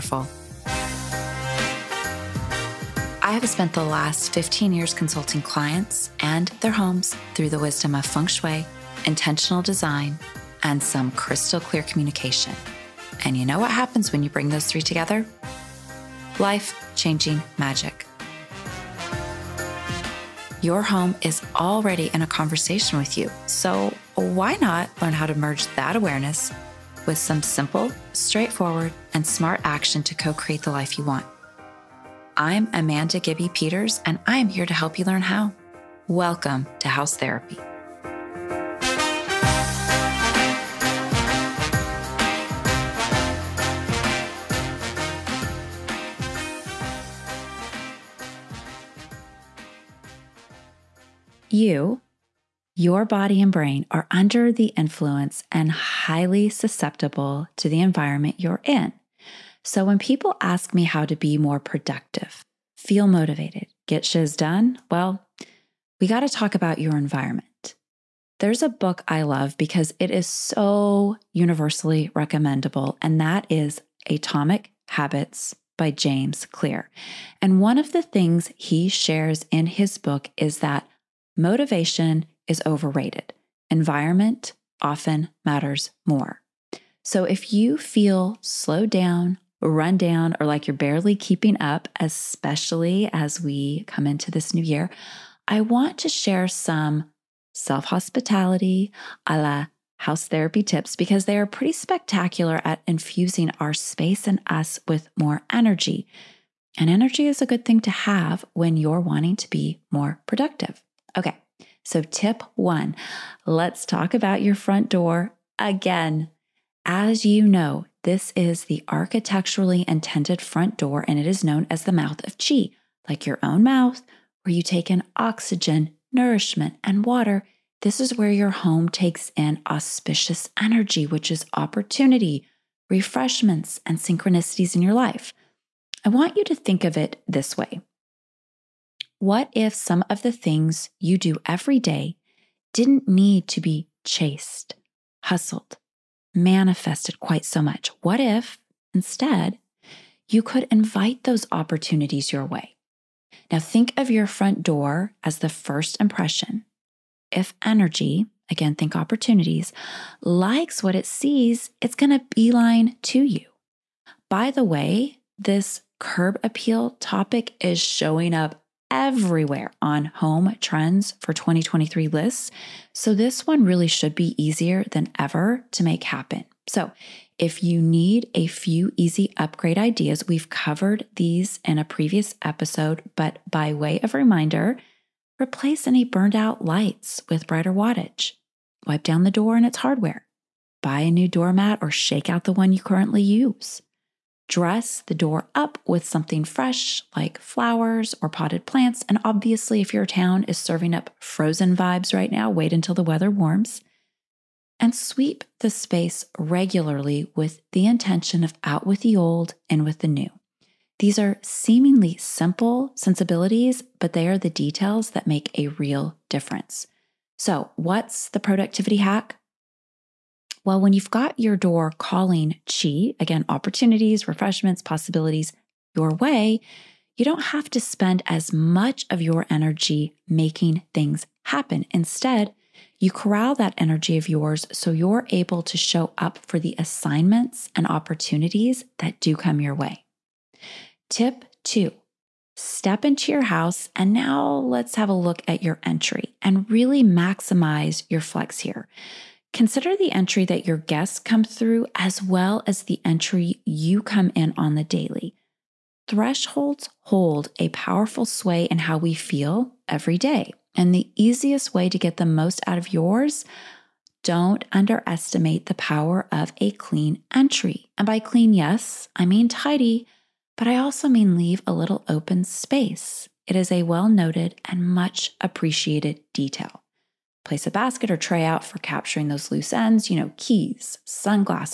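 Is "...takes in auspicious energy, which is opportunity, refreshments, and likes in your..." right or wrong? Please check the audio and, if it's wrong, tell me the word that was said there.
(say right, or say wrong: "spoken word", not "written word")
wrong: "synchronicities", not "likes".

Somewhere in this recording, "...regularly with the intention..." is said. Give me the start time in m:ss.
3:26.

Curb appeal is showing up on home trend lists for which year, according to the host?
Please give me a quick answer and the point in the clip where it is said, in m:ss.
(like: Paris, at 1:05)
2023, at 2:51.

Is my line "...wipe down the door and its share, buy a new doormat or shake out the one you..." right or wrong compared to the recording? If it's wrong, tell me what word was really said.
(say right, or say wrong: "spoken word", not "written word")
wrong: "hardware", not "share".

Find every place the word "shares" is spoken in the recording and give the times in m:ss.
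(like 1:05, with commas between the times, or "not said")
1:18, 1:36.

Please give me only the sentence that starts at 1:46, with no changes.
And energy is a good thing to have when you're wanting to be more productive.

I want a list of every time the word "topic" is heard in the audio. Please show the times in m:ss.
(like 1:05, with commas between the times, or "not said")
2:46.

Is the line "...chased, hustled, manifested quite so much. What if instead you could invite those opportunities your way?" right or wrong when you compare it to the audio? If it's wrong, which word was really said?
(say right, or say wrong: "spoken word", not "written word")
right.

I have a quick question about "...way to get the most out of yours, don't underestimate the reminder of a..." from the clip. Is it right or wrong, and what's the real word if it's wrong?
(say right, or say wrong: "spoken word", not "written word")
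wrong: "power", not "reminder".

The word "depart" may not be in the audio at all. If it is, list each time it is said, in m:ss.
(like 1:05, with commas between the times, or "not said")
not said.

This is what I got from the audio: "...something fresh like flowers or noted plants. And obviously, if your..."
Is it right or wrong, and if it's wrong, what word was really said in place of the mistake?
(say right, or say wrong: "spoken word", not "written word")
wrong: "potted", not "noted".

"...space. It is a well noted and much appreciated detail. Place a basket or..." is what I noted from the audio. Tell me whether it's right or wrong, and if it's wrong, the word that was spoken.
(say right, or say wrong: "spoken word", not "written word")
right.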